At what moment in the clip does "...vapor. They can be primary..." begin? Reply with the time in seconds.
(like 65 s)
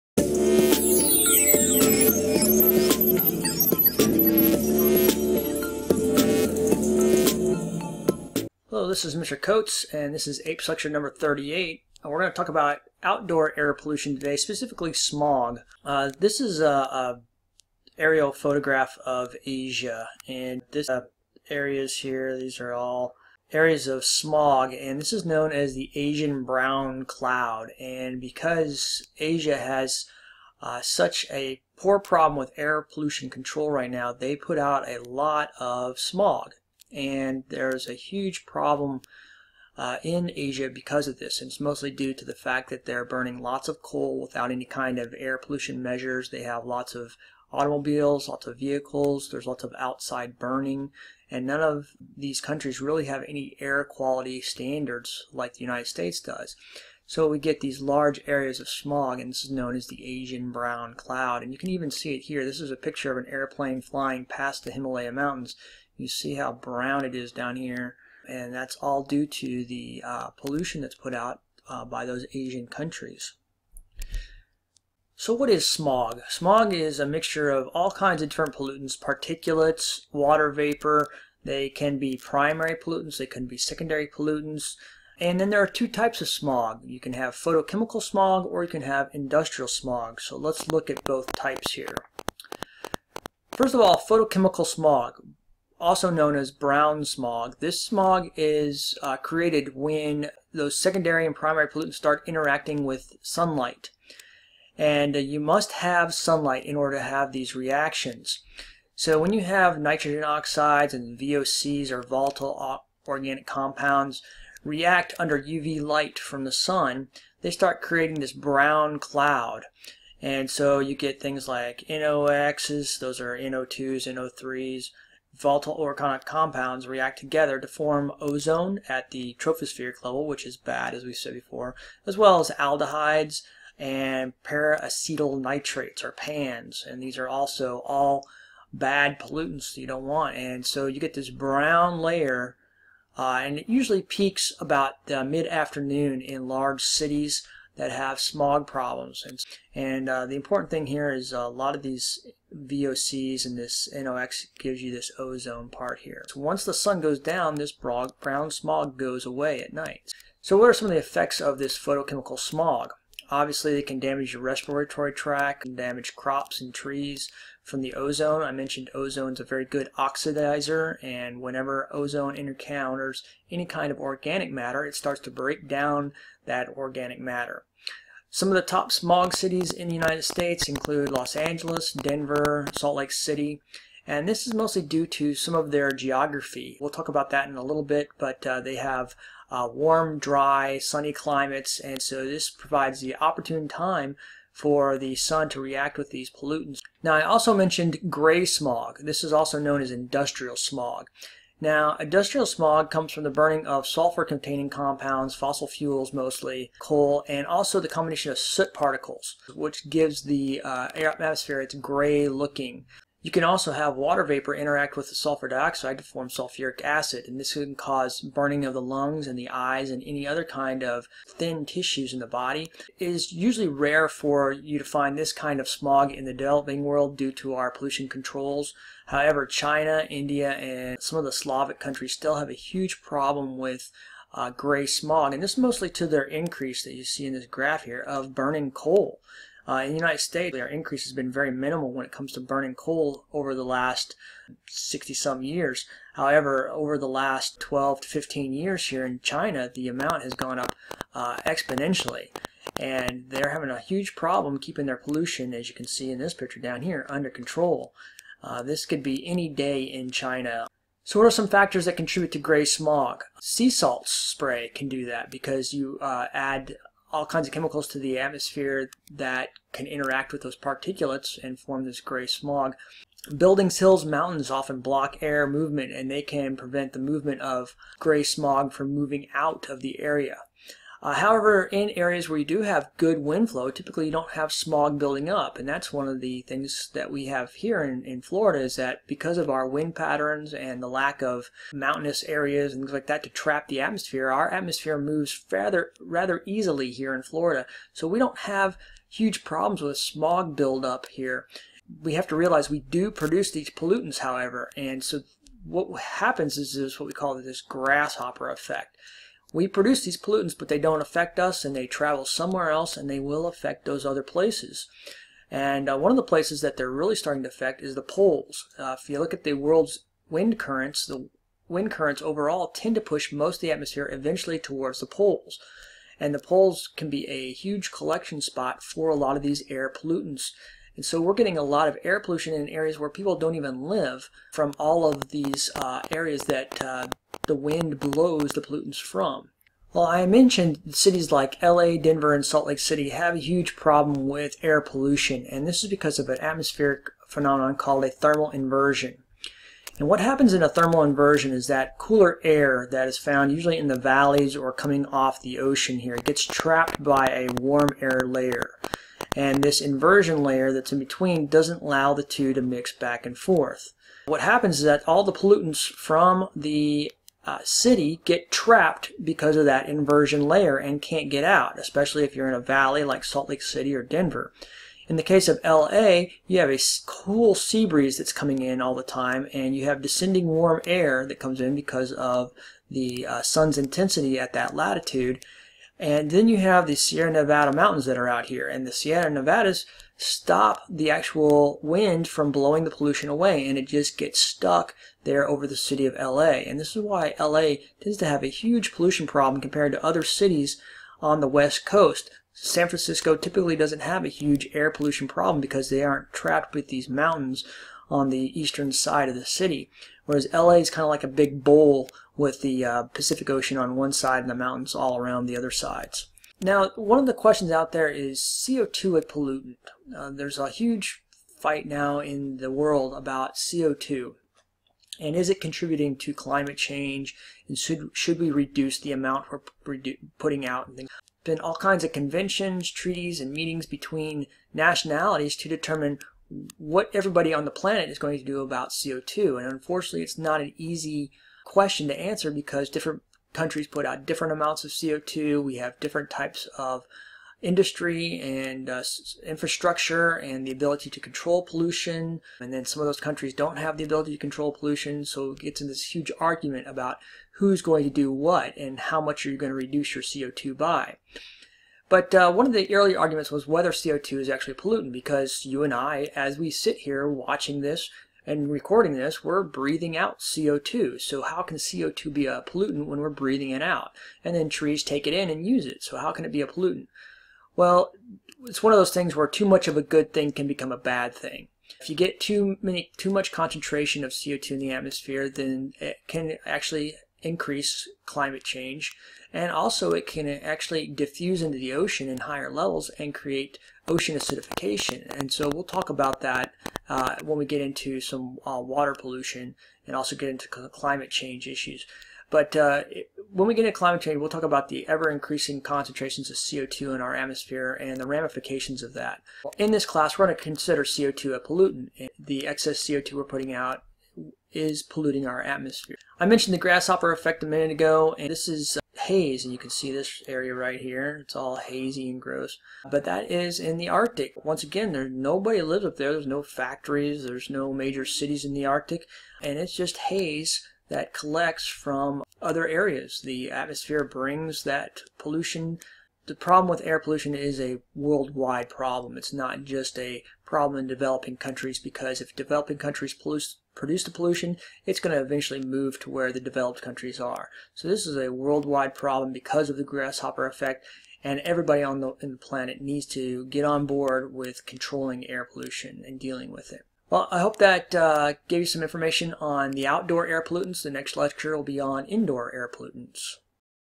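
80 s.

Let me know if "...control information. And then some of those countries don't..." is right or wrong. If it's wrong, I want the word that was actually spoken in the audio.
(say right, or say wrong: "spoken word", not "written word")
wrong: "pollution", not "information".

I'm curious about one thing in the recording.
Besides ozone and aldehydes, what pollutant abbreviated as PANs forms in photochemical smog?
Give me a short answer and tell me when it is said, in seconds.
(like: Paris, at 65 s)
peroxyacetyl nitrates, at 134 s.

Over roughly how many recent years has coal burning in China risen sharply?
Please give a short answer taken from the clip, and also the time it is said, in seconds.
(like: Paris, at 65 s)
12 to 15 years, at 247 s.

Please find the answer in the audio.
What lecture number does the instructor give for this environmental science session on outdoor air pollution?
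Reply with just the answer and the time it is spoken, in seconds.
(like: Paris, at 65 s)
38, at 11 s.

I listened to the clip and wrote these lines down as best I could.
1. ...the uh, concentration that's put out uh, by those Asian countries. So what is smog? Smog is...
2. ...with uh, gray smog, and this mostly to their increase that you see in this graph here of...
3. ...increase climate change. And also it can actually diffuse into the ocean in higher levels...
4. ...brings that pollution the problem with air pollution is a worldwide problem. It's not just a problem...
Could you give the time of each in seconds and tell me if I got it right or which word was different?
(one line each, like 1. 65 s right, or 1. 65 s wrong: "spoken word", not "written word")
1. 69 s wrong: "pollution", not "concentration"
2. 233 s right
3. 487 s right
4. 534 s right.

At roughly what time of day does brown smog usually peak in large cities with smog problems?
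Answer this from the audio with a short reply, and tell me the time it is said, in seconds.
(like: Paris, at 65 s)
mid-afternoon, at 145 s.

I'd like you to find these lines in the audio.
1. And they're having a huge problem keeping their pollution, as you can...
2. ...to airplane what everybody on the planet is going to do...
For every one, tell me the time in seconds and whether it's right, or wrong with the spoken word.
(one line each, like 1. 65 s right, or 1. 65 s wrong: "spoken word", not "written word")
1. 252 s right
2. 435 s wrong: "determine", not "airplane".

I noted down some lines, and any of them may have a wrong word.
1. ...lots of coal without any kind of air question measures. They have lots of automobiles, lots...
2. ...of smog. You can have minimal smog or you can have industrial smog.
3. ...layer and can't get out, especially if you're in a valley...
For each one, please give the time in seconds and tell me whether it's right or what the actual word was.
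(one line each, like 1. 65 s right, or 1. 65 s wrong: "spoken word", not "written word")
1. 43 s wrong: "pollution", not "question"
2. 86 s wrong: "photochemical", not "minimal"
3. 370 s right.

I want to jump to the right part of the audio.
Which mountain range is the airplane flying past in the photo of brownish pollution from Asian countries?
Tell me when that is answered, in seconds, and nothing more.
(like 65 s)
64 s.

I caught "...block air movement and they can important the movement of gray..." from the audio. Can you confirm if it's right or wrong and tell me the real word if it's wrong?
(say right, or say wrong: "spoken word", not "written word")
wrong: "prevent", not "important".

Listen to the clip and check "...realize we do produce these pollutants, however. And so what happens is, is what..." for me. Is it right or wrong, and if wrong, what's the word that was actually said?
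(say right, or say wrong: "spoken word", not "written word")
right.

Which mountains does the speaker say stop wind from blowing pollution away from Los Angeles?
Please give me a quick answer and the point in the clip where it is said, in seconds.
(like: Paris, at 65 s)
Sierra Nevada, at 386 s.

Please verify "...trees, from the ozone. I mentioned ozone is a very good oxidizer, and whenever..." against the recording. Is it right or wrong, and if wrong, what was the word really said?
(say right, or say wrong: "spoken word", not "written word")
right.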